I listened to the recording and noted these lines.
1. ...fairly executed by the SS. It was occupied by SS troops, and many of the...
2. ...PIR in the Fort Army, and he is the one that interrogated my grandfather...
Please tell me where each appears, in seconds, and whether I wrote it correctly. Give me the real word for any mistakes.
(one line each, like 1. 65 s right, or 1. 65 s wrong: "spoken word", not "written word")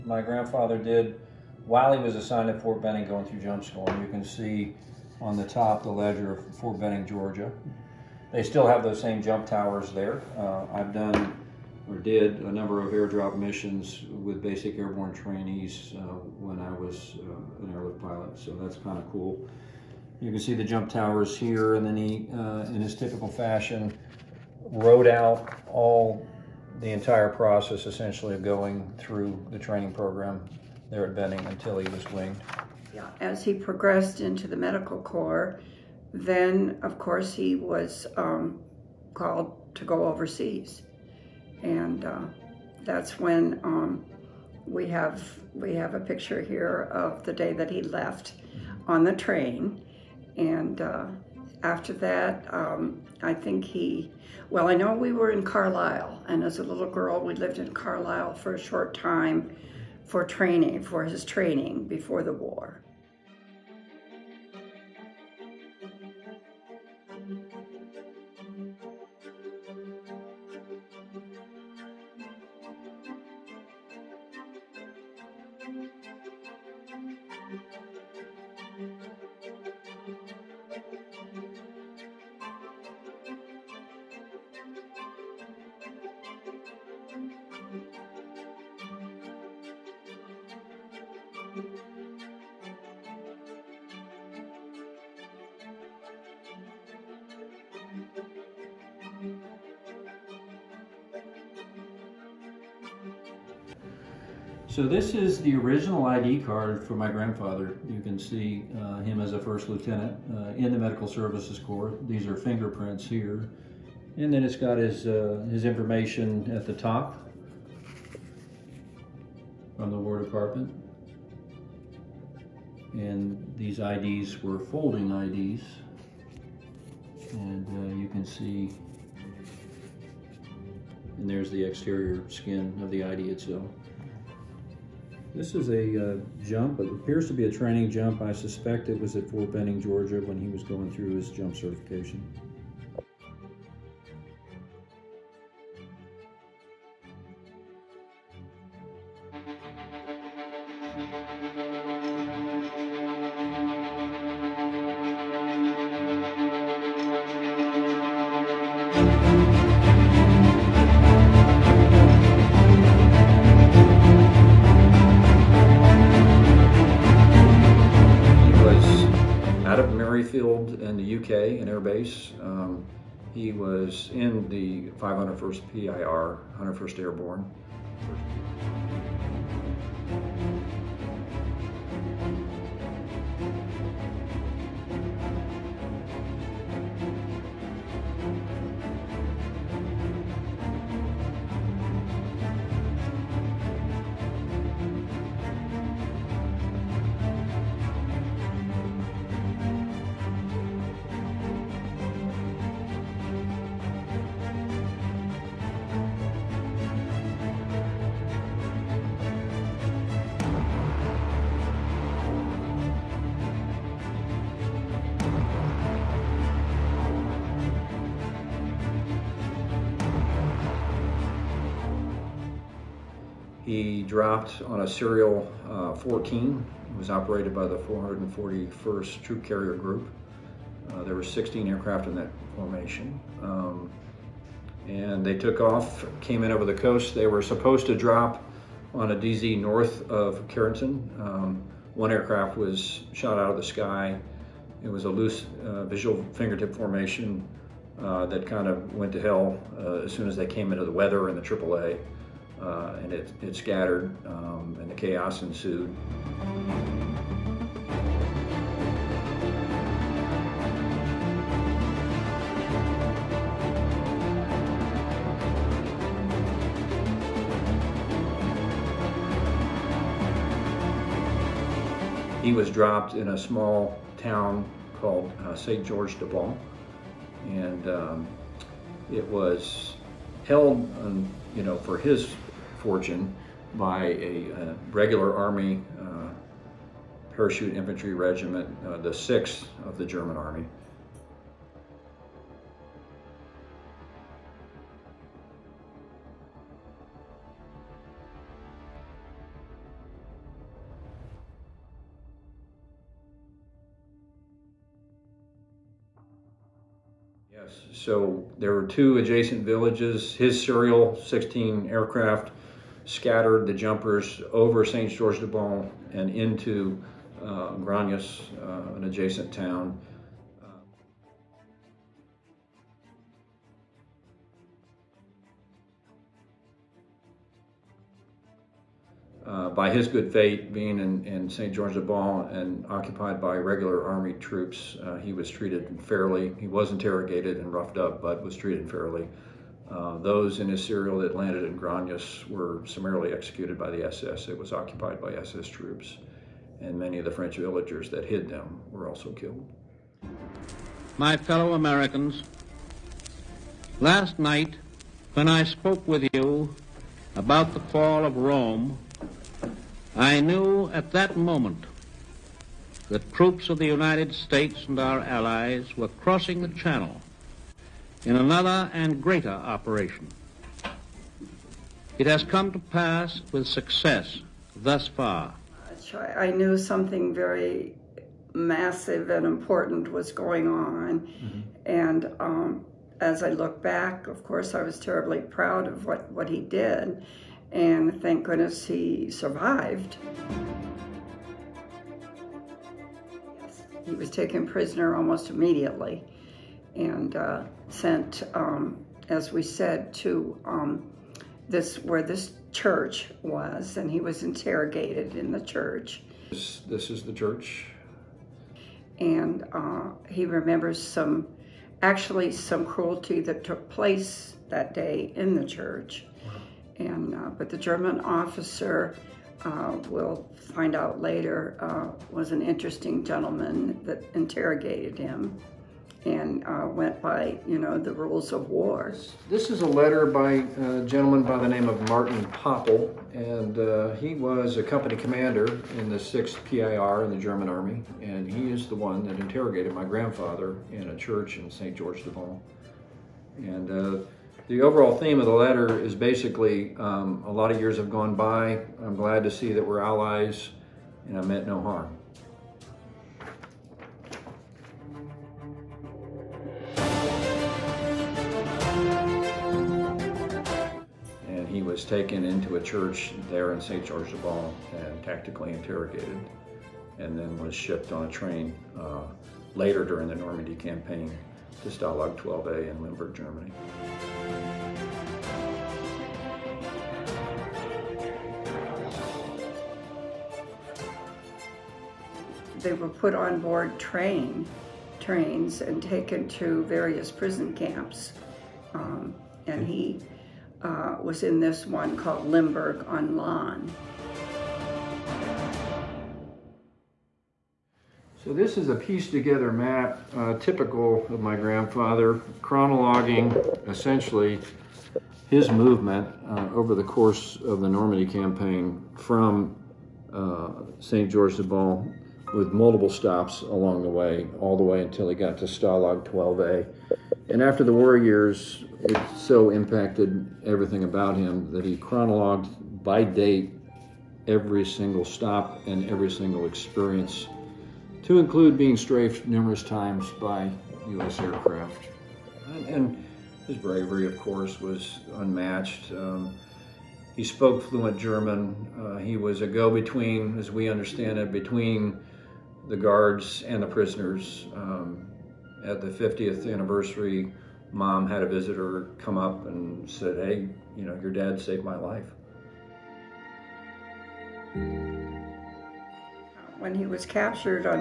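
1. 342 s wrong: "summarily", not "fairly"
2. 436 s wrong: "German", not "Fort".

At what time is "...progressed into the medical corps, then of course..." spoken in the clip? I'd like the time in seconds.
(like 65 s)
33 s.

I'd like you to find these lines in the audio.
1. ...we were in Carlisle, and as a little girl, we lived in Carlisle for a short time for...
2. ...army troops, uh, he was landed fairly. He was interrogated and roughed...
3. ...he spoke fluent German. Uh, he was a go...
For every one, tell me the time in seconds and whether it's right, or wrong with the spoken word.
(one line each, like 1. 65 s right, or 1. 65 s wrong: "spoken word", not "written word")
1. 54 s right
2. 334 s wrong: "treated", not "landed"
3. 537 s right.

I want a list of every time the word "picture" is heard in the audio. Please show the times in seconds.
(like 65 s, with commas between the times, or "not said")
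45 s.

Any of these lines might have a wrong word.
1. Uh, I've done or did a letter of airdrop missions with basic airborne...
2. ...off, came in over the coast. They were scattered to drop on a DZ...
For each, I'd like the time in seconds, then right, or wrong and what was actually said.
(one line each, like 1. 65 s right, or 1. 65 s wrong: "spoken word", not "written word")
1. 10 s wrong: "number", not "letter"
2. 235 s wrong: "supposed", not "scattered".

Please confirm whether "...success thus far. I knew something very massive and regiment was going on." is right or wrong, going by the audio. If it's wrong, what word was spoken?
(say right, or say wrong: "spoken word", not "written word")
wrong: "important", not "regiment".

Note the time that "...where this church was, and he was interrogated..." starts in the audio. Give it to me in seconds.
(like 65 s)
401 s.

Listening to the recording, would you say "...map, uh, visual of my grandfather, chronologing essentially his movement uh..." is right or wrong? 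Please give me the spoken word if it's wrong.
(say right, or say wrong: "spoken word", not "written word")
wrong: "typical", not "visual".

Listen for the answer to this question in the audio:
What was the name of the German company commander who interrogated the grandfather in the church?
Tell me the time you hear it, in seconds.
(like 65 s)
432 s.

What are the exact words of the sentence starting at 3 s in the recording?
And you can see on the top the ledger of Fort Benning, Georgia.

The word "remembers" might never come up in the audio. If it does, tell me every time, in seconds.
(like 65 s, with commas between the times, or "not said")
410 s.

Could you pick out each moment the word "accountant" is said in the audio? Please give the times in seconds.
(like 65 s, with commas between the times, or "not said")
not said.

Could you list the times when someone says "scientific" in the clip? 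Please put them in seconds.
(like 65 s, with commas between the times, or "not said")
not said.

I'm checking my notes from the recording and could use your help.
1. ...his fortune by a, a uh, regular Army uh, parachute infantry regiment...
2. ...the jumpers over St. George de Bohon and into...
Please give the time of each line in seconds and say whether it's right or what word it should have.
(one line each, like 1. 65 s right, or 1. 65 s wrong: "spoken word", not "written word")
1. 281 s right
2. 313 s right.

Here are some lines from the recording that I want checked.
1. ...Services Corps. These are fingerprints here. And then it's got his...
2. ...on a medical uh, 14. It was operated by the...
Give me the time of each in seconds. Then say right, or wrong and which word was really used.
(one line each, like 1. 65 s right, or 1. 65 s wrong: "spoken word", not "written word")
1. 111 s right
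2. 224 s wrong: "serial", not "medical".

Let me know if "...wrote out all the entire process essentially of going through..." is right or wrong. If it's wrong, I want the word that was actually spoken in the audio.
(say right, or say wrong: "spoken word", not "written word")
right.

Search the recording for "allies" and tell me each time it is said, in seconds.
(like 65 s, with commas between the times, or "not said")
365 s, 450 s.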